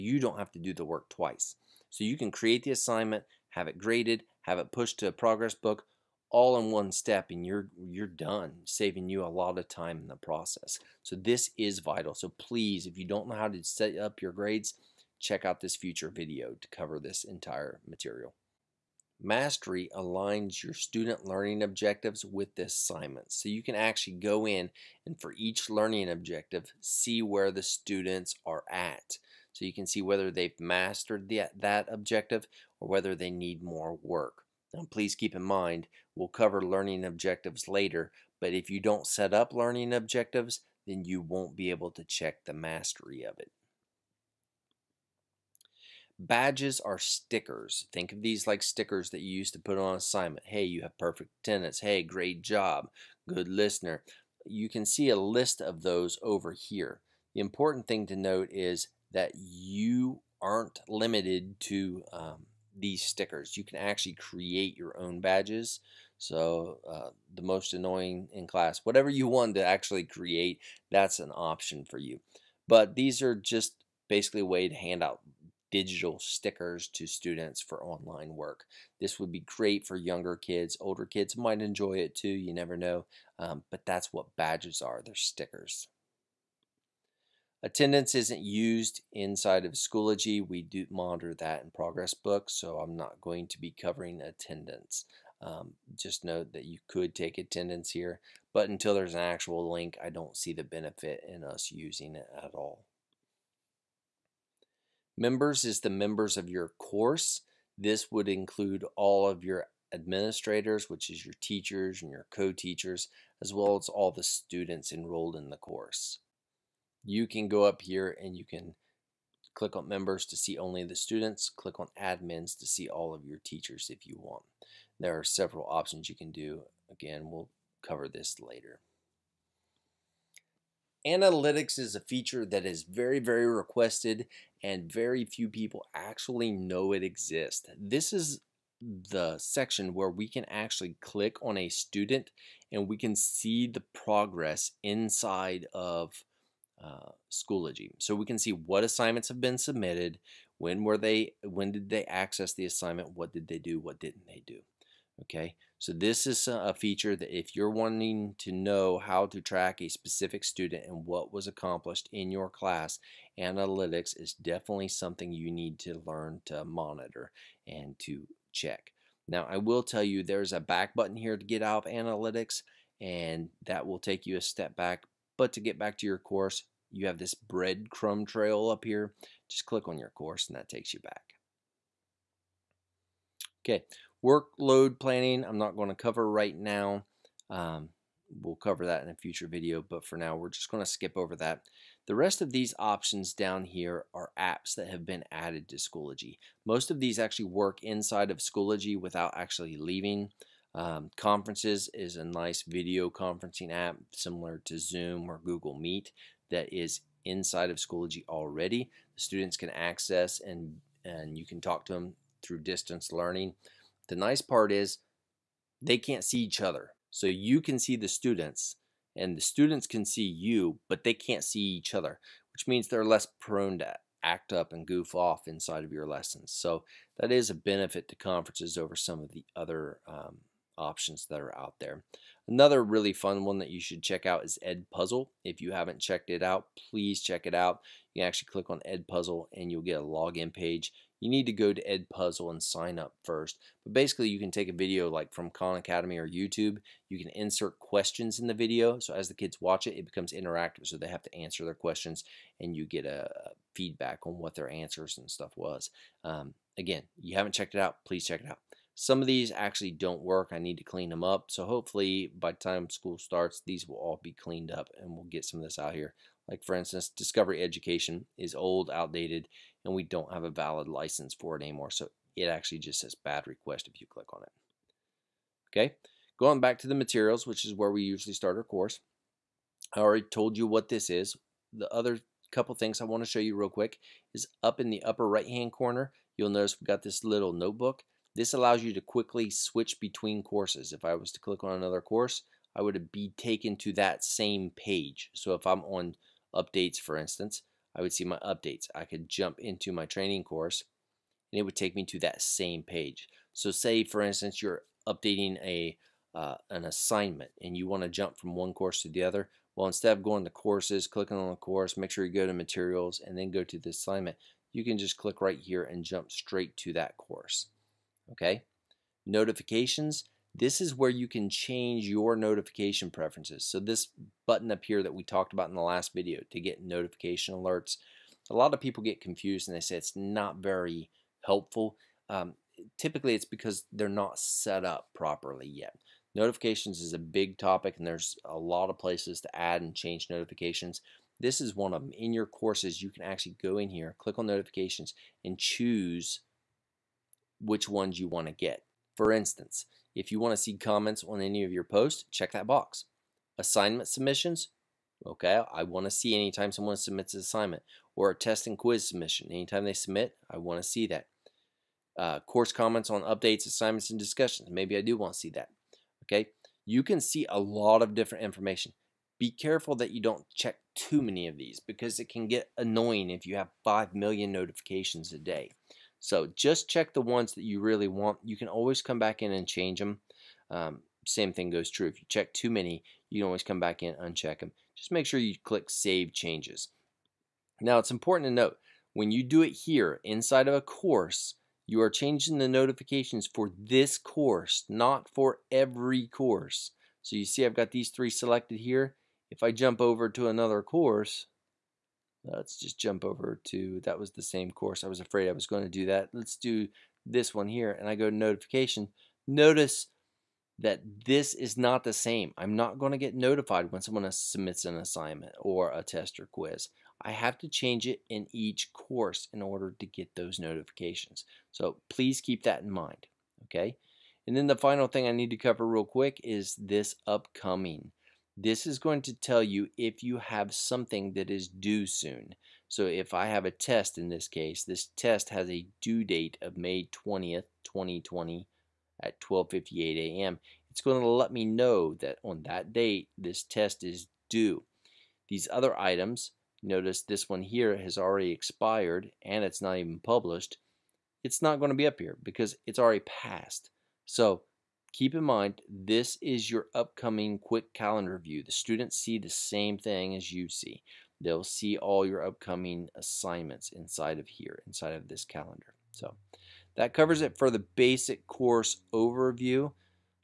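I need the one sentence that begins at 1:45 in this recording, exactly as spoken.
Members is the members of your course.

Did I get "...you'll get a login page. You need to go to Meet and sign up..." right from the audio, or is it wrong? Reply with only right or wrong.
wrong.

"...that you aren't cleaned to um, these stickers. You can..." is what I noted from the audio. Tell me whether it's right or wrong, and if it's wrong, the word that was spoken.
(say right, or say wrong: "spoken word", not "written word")
wrong: "limited", not "cleaned".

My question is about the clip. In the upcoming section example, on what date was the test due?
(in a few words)
May 20th, 2020.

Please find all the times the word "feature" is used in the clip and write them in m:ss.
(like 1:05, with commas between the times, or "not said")
2:11, 2:36.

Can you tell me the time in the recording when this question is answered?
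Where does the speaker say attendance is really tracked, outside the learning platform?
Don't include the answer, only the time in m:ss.
1:31.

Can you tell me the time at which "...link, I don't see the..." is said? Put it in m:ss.
1:39.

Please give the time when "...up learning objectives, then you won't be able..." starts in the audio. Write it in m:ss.
0:39.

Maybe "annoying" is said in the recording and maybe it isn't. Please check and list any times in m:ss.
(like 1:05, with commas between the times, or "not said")
1:07, 6:12.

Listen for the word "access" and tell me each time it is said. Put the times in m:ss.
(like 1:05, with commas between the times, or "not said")
2:32, 3:29.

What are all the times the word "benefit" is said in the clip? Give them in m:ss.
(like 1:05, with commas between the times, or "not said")
1:40, 3:47.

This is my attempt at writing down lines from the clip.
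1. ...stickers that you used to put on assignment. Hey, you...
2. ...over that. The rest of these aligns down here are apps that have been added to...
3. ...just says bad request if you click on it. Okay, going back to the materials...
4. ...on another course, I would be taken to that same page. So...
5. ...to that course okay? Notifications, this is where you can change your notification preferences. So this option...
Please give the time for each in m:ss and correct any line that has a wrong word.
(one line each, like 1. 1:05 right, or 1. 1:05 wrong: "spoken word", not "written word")
1. 0:48 right
2. 3:11 wrong: "options", not "aligns"
3. 4:32 right
4. 4:51 right
5. 5:16 wrong: "button", not "option".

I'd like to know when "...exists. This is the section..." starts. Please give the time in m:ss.
2:17.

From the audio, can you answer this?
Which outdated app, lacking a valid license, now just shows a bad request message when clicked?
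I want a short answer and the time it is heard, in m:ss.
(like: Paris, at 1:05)
Discovery Education, at 4:27.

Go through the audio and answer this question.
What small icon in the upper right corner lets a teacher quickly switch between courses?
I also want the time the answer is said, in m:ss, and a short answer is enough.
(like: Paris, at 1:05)
notebook, at 4:47.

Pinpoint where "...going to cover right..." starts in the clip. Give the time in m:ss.
3:05.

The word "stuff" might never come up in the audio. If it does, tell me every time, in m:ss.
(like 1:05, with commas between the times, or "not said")
4:15.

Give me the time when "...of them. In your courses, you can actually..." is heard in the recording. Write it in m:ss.
5:41.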